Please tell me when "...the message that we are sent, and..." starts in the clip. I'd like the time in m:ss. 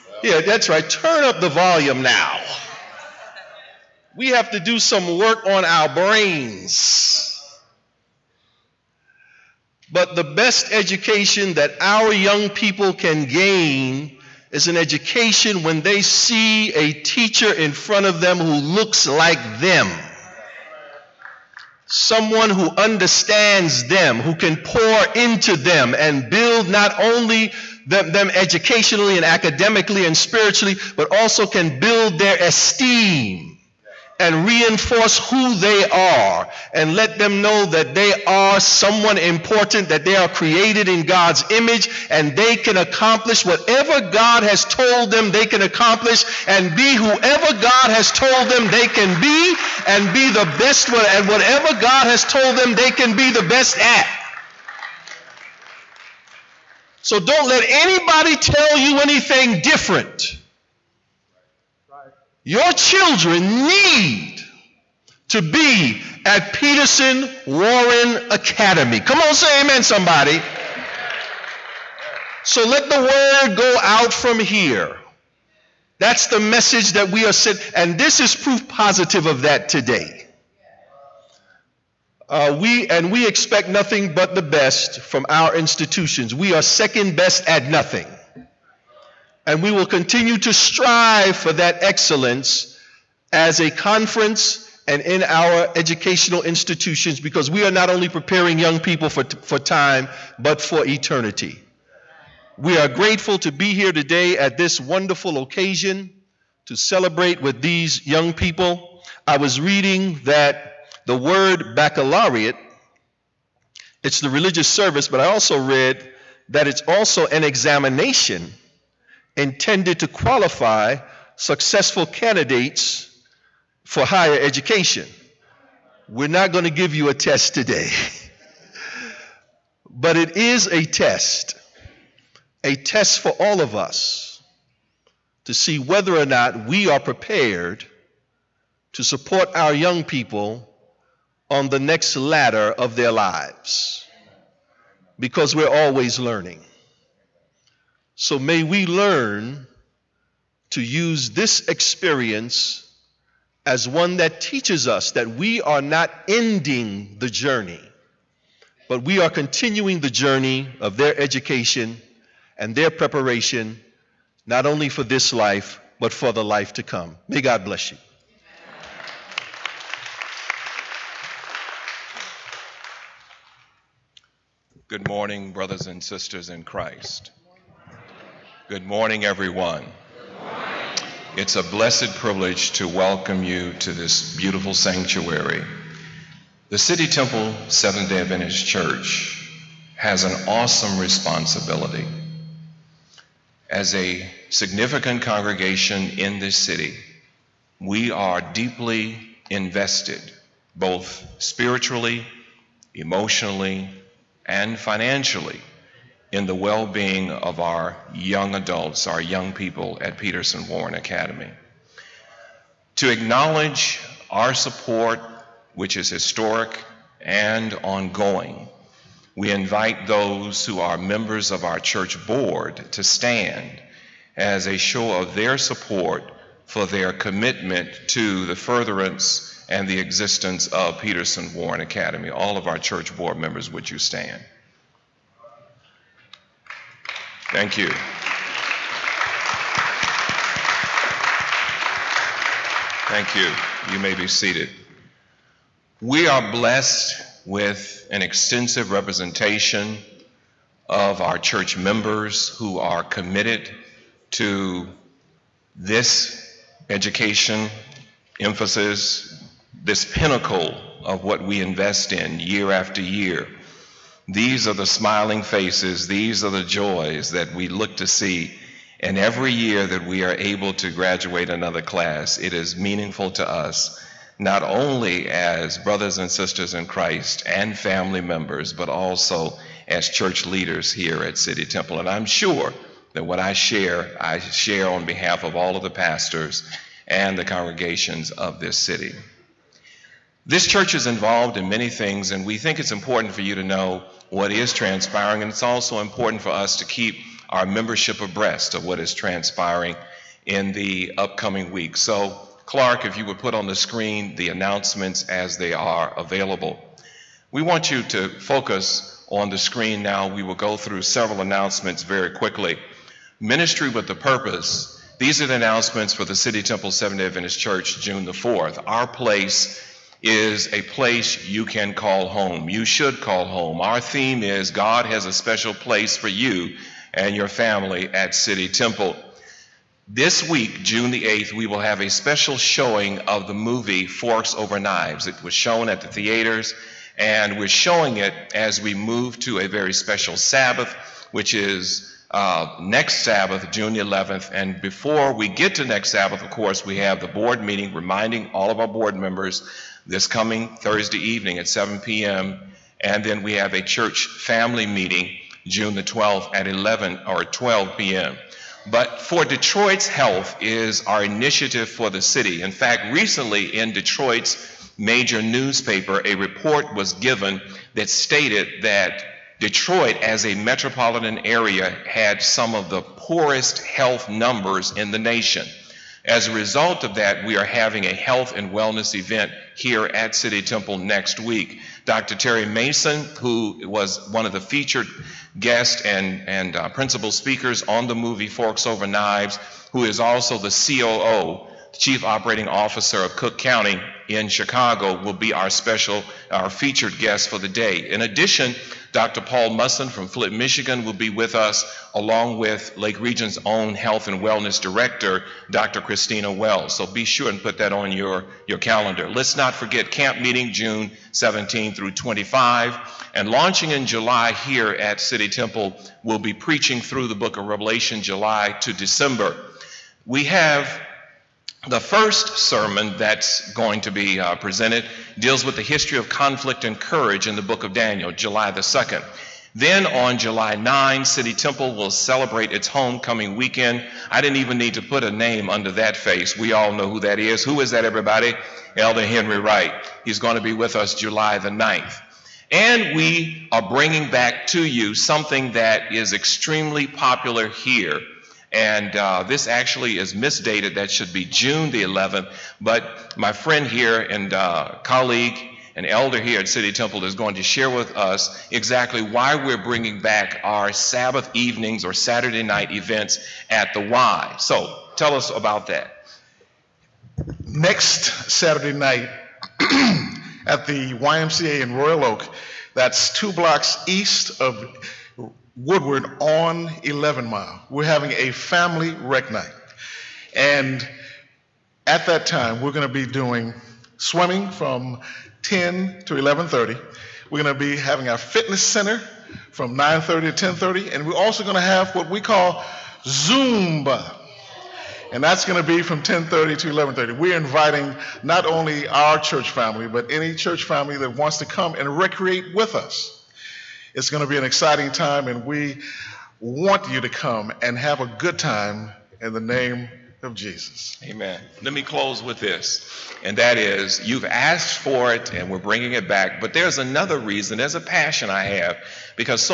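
1:16.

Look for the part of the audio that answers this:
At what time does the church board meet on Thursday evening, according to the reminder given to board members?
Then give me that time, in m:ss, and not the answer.
5:51.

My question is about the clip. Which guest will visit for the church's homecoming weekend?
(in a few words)
Henry Wright.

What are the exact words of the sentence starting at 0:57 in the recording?
So don't let anybody tell you anything different.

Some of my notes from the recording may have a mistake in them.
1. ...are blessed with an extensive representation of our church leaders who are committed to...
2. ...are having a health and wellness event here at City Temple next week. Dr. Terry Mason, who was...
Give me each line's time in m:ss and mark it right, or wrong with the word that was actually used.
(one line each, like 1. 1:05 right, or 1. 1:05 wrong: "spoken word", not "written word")
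1. 4:06 wrong: "members", not "leaders"
2. 6:17 right.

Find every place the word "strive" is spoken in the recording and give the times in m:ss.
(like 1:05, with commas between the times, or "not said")
1:30.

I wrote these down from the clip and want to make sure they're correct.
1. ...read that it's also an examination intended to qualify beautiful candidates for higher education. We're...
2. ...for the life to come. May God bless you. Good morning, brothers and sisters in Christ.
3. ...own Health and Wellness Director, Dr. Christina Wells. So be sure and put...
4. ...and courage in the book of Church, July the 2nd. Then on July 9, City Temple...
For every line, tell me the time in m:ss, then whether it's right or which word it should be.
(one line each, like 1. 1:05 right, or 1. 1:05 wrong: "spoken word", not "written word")
1. 1:55 wrong: "successful", not "beautiful"
2. 2:46 right
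3. 6:43 right
4. 7:06 wrong: "Daniel", not "Church".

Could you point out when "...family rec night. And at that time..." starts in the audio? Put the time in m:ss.
7:58.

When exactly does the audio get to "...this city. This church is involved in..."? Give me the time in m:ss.
4:48.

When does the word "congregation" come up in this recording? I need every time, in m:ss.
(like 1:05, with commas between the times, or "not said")
3:15, 4:47.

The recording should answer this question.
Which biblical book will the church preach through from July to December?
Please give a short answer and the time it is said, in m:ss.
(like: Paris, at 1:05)
Revelation, at 6:57.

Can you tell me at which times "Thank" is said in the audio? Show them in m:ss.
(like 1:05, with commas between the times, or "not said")
3:57, 4:03.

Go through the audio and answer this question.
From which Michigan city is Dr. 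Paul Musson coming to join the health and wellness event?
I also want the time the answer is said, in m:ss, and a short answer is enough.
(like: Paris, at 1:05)
Flint, at 6:40.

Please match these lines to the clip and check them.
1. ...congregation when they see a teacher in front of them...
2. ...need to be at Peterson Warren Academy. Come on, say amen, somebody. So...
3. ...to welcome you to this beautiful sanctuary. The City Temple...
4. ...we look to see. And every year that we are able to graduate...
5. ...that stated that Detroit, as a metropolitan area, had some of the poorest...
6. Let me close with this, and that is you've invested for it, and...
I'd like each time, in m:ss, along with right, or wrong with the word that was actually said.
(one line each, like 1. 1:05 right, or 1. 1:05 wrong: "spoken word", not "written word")
1. 0:14 wrong: "education", not "congregation"
2. 1:03 right
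3. 3:02 right
4. 4:27 right
5. 6:07 right
6. 8:31 wrong: "asked", not "invested".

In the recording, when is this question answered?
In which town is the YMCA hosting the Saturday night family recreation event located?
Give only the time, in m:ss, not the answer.
7:51.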